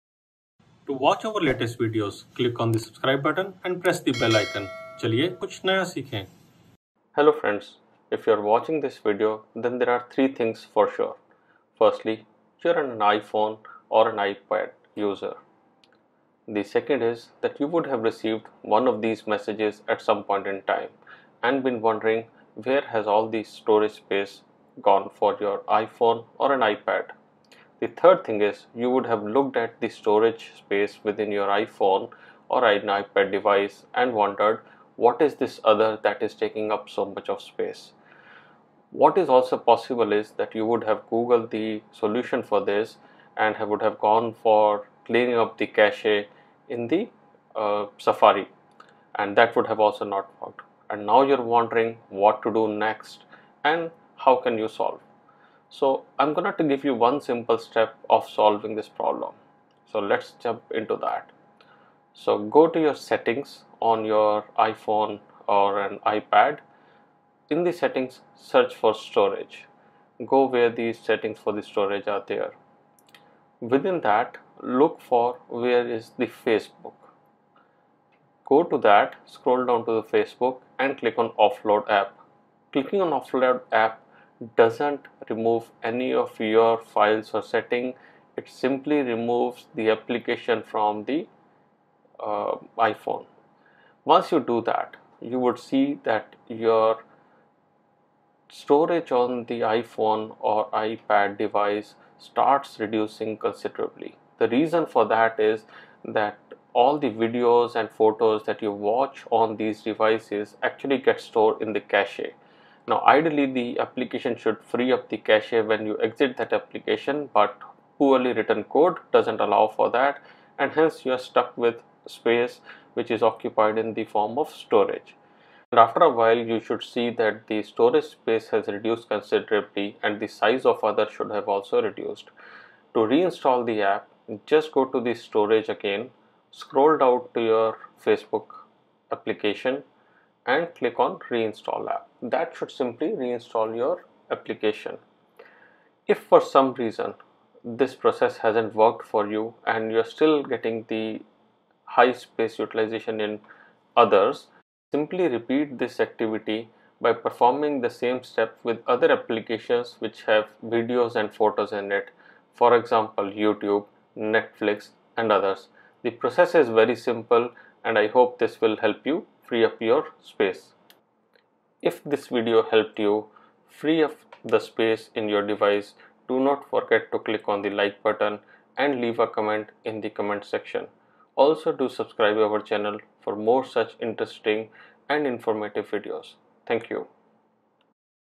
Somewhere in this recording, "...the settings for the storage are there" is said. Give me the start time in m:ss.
1:10.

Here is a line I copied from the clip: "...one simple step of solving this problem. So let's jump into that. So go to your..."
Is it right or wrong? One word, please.
right.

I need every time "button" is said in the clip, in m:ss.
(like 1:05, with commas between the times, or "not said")
0:03, 2:58.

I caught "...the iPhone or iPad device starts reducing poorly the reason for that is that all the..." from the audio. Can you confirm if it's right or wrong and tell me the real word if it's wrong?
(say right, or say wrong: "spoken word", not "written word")
wrong: "considerably", not "poorly".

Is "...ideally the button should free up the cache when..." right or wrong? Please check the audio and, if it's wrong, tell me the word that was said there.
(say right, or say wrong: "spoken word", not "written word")
wrong: "application", not "button".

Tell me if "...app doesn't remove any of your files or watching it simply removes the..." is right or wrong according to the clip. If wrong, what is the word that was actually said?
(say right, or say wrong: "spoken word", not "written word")
wrong: "setting", not "watching".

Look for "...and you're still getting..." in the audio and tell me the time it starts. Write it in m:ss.
2:29.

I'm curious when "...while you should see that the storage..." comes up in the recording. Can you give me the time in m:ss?
2:06.